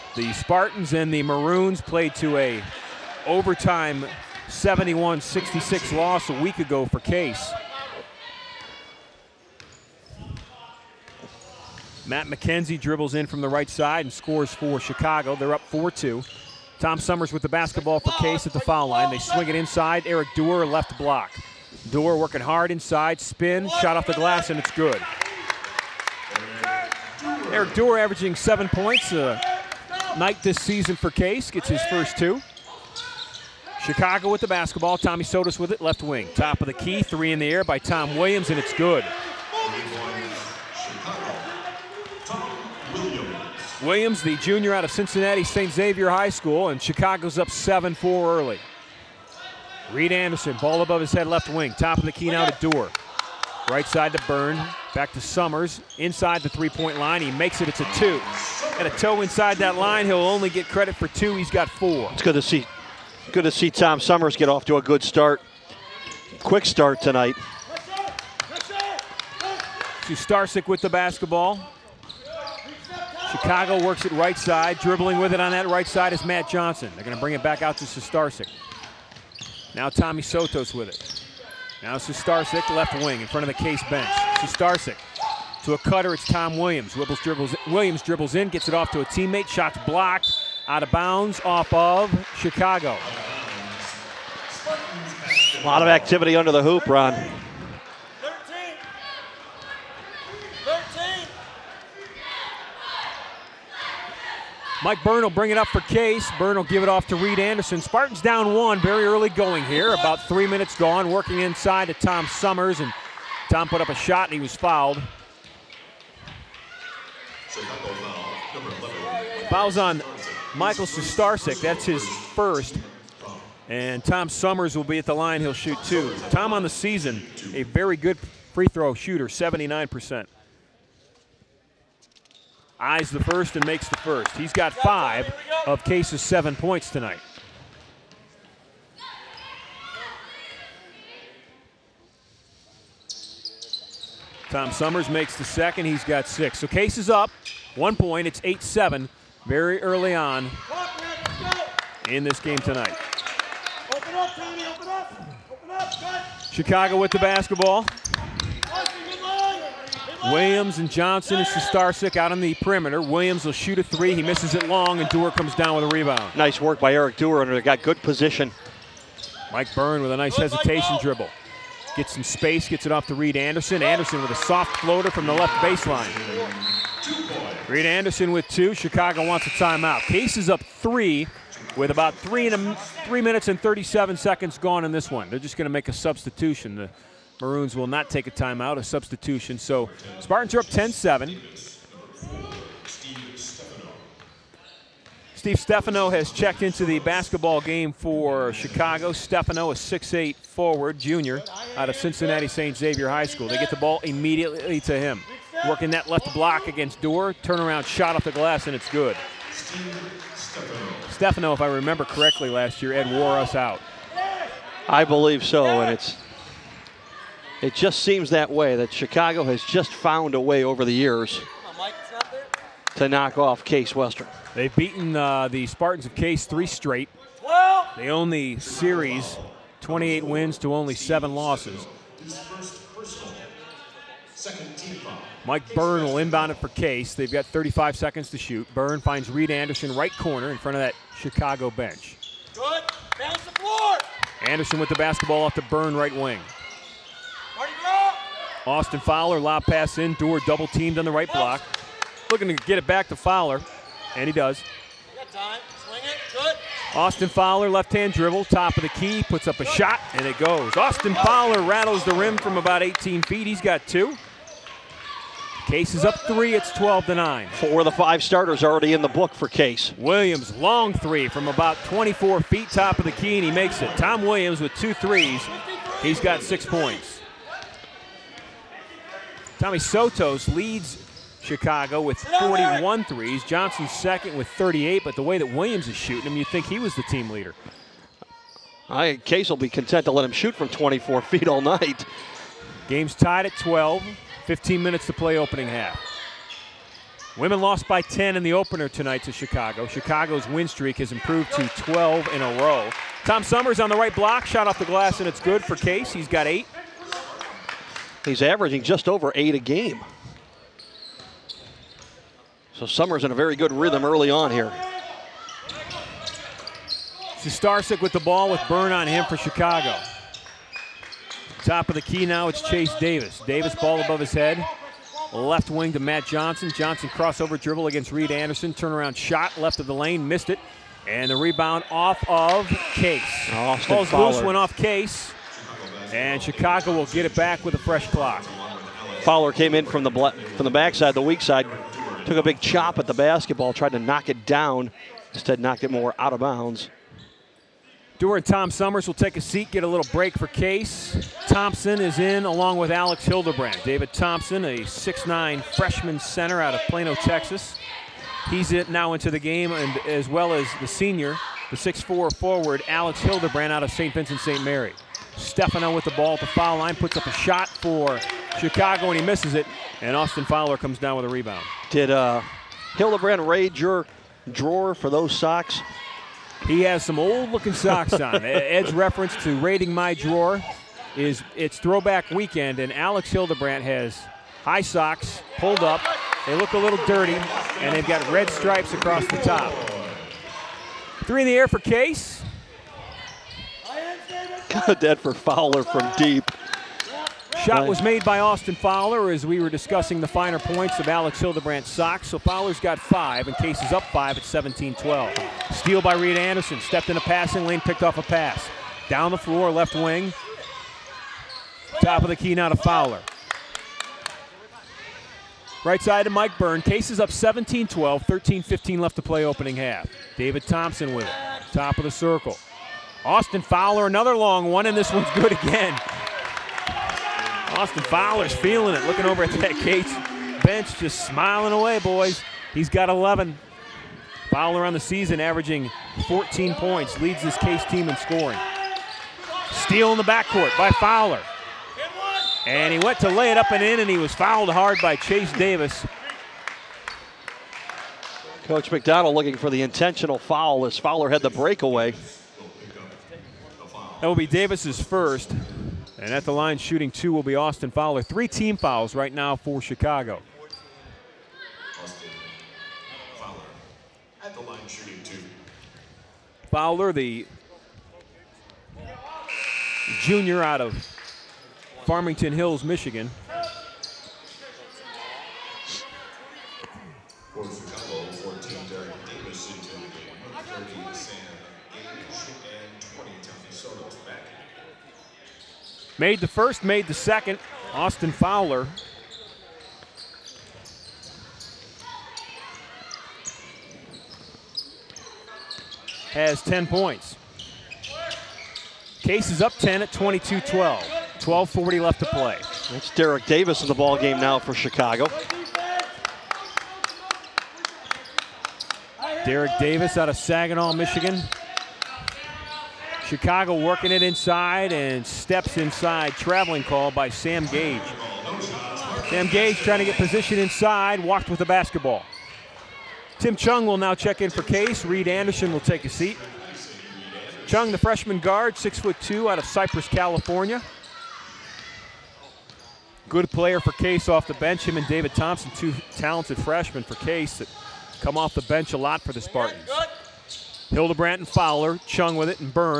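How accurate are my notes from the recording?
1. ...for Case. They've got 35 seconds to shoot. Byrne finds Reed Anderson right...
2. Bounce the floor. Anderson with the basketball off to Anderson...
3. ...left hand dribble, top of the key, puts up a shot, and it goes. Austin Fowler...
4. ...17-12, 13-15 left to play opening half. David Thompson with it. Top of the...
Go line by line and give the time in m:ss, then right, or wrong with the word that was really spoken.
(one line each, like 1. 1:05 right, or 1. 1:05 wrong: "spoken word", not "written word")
1. 3:56 right
2. 4:03 wrong: "Byrne", not "Anderson"
3. 4:17 right
4. 6:57 right.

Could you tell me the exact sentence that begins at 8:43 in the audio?
Tim Chung will now check in for Case.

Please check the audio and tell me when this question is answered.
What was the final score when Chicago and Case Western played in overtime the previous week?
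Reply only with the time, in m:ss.
0:04.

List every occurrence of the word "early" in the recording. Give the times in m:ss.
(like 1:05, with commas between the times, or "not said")
0:48, 1:49, 2:29, 5:14.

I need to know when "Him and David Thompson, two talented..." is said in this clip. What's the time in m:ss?
8:54.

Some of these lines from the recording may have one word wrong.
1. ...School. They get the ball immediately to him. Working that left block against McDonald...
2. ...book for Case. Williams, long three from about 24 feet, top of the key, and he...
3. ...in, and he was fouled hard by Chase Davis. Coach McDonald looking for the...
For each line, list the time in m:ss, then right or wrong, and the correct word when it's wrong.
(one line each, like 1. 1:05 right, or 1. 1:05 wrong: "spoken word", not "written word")
1. 3:23 wrong: "Dewar", not "McDonald"
2. 4:29 right
3. 7:23 right.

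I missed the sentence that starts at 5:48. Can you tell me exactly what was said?
Dewar and Tom Summers will take a seat, get a little break for Case.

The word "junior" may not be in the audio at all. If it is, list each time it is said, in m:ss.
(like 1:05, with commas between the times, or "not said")
0:44, 3:20, 7:50.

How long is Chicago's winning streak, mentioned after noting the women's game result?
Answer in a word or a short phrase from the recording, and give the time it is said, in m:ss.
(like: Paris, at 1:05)
12, at 5:01.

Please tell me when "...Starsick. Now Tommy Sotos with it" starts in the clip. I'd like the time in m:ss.
1:17.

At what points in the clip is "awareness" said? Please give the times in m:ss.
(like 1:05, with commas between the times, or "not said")
not said.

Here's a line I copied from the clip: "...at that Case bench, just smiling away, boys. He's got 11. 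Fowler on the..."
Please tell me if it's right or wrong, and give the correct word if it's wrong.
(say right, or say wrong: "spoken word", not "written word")
right.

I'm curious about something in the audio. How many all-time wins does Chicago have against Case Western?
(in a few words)
28.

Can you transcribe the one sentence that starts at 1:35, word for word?
A lot of activity under the hoop, Ron.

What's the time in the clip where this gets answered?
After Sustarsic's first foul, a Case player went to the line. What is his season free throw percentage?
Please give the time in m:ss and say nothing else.
2:09.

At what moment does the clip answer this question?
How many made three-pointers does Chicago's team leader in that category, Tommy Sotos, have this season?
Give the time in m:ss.
4:42.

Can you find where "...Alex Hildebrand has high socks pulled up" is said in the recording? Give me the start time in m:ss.
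6:22.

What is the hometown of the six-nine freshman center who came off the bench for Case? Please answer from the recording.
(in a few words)
Plano, Texas.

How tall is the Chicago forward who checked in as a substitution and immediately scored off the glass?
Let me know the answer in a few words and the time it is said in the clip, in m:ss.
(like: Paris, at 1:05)
6'8, at 3:19.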